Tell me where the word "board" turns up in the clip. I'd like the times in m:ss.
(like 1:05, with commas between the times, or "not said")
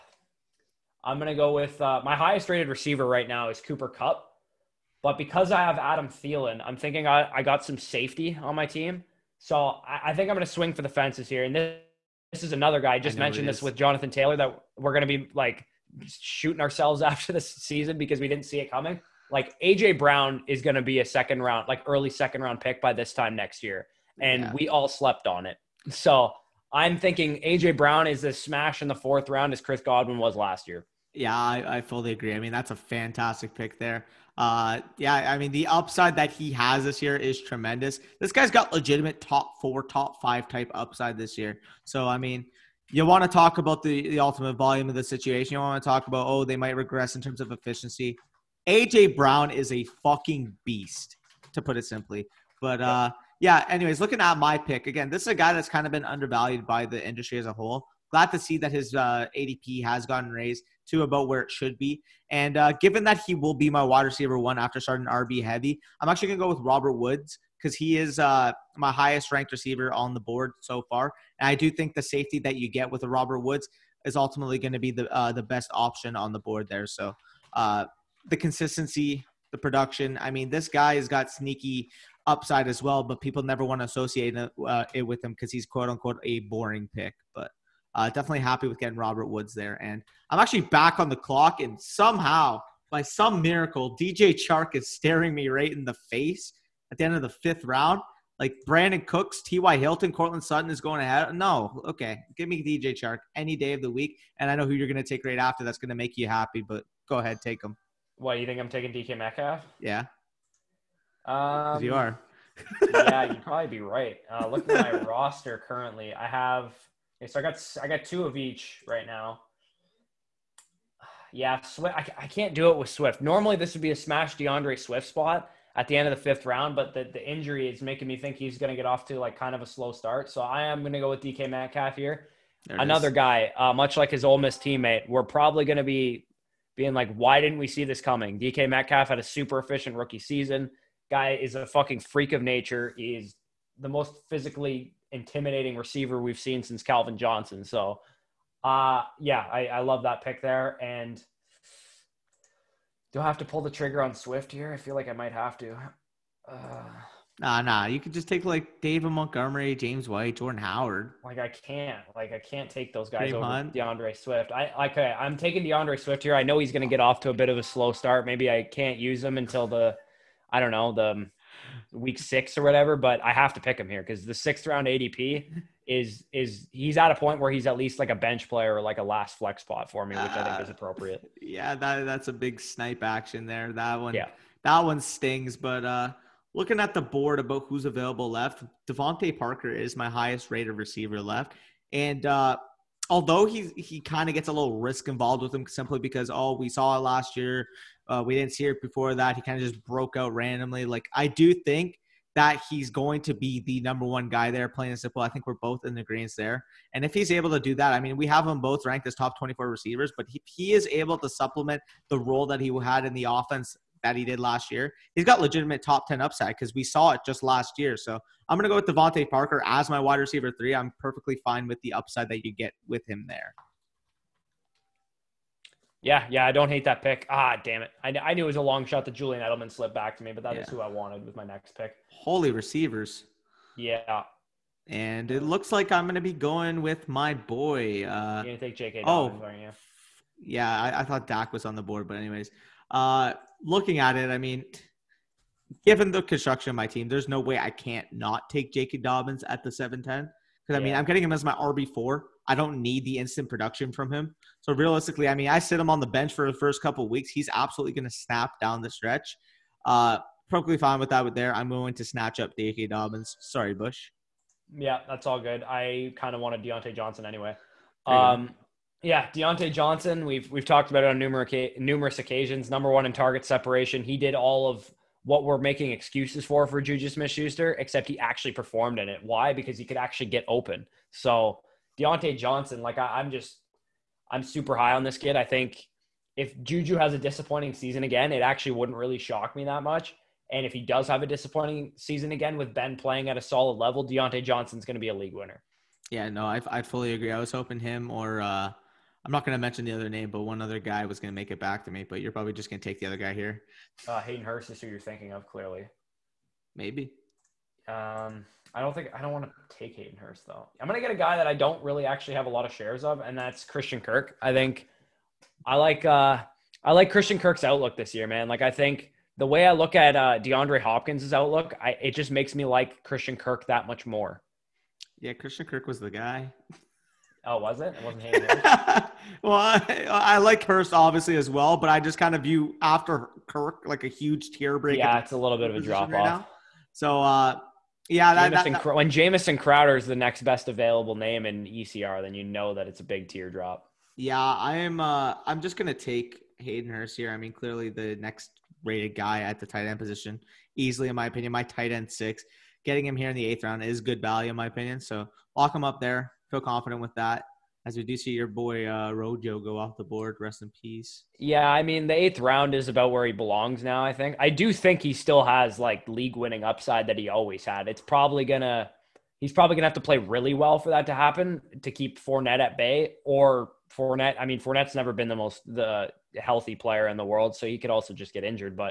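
1:10, 1:16, 3:07, 4:01, 6:00.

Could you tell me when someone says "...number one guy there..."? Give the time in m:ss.
3:23.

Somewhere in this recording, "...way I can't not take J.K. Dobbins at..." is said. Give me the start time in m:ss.
4:07.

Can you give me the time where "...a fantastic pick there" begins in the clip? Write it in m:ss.
0:32.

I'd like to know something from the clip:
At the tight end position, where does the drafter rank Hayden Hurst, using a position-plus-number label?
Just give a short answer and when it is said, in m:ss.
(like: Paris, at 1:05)
tight end six, at 5:51.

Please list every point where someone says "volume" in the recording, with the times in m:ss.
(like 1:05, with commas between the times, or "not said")
0:44.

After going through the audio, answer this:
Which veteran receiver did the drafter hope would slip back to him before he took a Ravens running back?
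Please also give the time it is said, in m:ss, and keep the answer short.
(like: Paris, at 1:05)
Julian Edelman, at 3:49.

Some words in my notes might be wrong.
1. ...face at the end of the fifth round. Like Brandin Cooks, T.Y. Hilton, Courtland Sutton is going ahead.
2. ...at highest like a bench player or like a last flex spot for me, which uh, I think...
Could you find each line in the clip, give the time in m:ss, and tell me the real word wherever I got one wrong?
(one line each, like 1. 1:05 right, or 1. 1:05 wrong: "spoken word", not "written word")
1. 1:36 right
2. 2:57 wrong: "least", not "highest".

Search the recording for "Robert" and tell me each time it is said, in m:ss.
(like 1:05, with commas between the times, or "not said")
1:06, 1:13, 1:28.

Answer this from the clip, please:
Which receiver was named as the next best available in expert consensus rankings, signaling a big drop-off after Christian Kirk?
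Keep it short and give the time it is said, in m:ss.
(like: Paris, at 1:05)
Jamison Crowder, at 5:39.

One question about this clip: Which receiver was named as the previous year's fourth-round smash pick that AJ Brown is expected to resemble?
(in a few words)
Chris Godwin.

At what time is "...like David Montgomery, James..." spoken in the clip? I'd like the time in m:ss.
2:38.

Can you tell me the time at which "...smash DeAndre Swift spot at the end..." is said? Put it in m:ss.
2:03.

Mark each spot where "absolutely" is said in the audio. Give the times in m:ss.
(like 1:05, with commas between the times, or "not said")
4:17.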